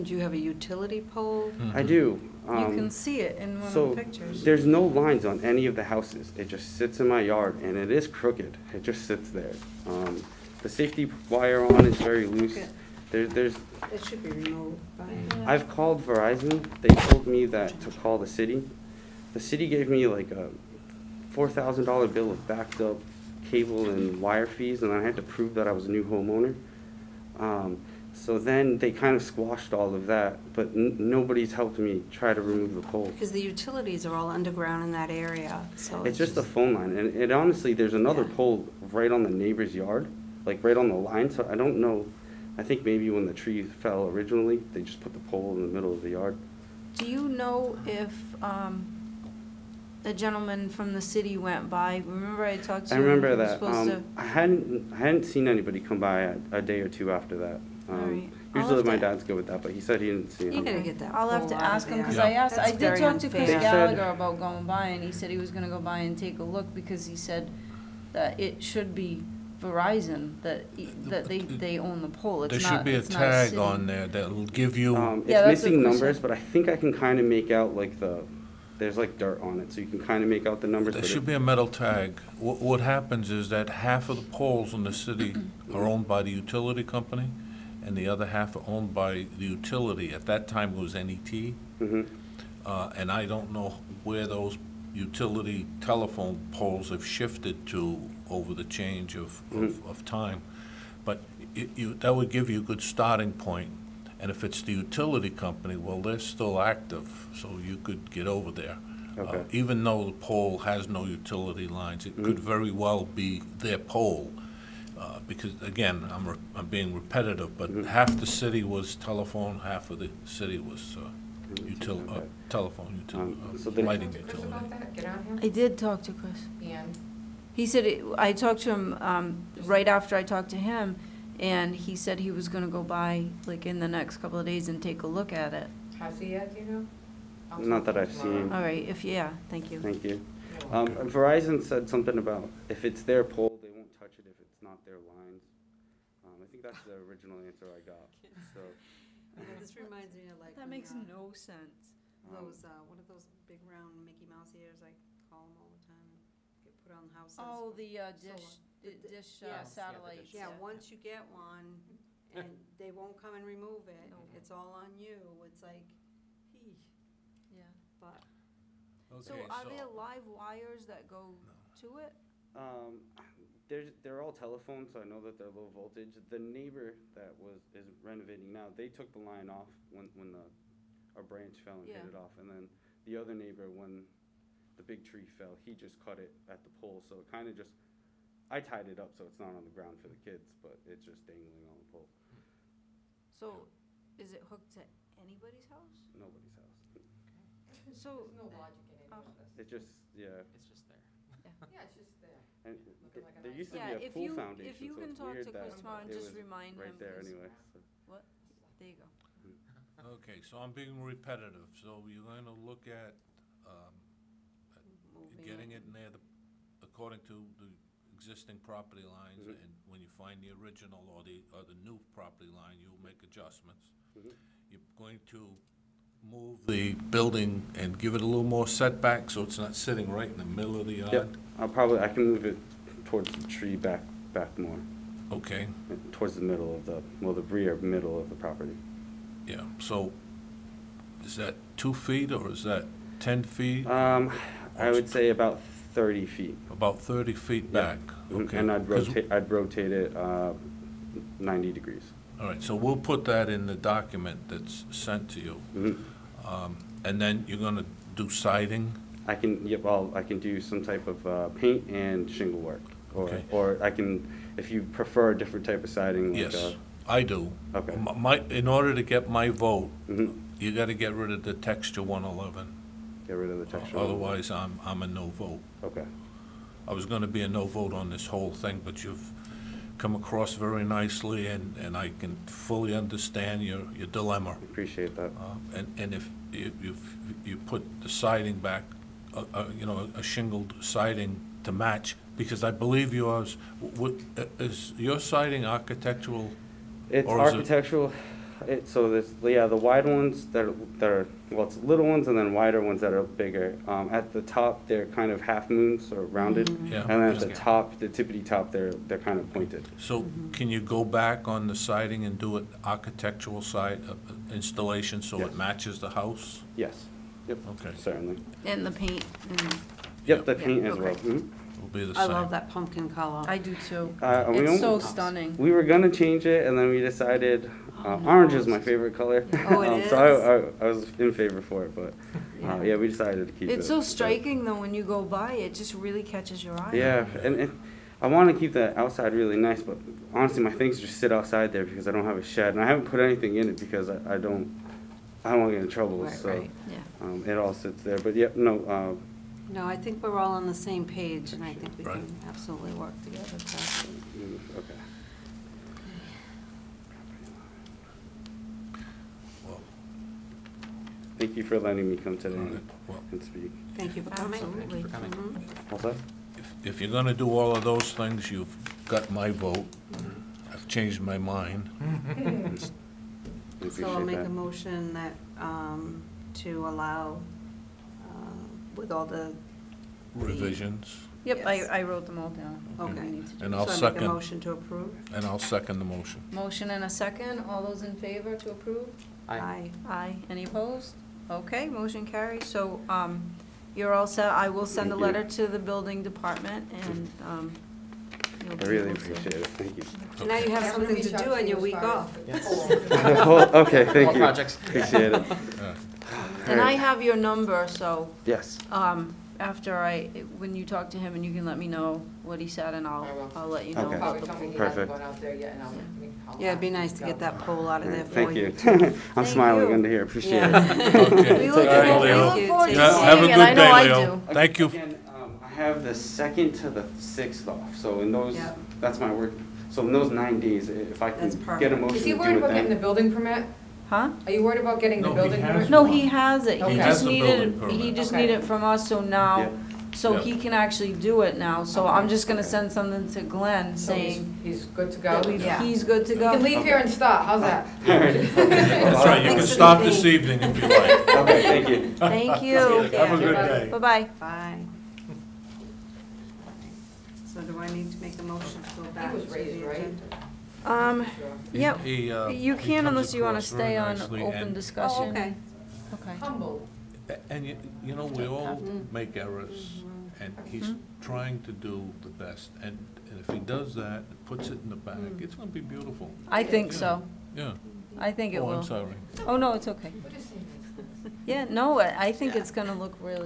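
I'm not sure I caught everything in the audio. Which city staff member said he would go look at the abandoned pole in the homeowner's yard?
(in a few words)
Chris Gallagher.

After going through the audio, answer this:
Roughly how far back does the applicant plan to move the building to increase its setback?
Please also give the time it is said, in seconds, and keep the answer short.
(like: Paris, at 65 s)
30 feet, at 245 s.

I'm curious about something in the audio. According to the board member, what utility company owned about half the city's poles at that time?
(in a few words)
NET.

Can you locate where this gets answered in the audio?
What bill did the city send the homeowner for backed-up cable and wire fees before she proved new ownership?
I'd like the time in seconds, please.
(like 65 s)
21 s.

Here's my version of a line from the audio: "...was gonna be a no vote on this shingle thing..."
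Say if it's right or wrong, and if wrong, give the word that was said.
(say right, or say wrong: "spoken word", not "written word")
wrong: "whole", not "shingle".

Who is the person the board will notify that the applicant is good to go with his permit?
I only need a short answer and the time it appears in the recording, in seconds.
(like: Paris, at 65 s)
Glenn, at 443 s.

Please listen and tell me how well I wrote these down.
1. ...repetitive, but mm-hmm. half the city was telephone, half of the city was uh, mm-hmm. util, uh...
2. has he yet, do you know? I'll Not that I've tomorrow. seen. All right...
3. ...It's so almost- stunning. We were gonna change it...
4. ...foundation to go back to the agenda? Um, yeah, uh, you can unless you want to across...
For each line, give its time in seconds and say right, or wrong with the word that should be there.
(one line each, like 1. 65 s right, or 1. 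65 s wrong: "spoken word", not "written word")
1. 116 s right
2. 135 s right
3. 324 s right
4. 458 s wrong: "motion", not "foundation".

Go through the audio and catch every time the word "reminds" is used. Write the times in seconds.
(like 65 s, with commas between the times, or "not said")
149 s, 206 s.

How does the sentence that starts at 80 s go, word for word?
there should be a metal tag.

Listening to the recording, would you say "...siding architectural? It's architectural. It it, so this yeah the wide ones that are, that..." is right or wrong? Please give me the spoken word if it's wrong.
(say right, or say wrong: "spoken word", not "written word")
right.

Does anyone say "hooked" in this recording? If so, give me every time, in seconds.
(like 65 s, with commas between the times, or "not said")
194 s.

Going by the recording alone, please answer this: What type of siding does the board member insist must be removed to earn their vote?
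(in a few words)
texture one eleven.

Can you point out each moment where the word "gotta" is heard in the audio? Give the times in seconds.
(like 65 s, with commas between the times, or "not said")
60 s, 270 s.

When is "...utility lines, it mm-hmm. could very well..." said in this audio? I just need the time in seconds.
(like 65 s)
111 s.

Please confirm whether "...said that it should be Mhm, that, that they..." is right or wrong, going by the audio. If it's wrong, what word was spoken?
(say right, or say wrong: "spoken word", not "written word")
wrong: "Verizon", not "Mhm".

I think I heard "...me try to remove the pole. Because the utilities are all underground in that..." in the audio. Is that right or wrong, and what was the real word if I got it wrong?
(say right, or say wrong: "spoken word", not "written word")
right.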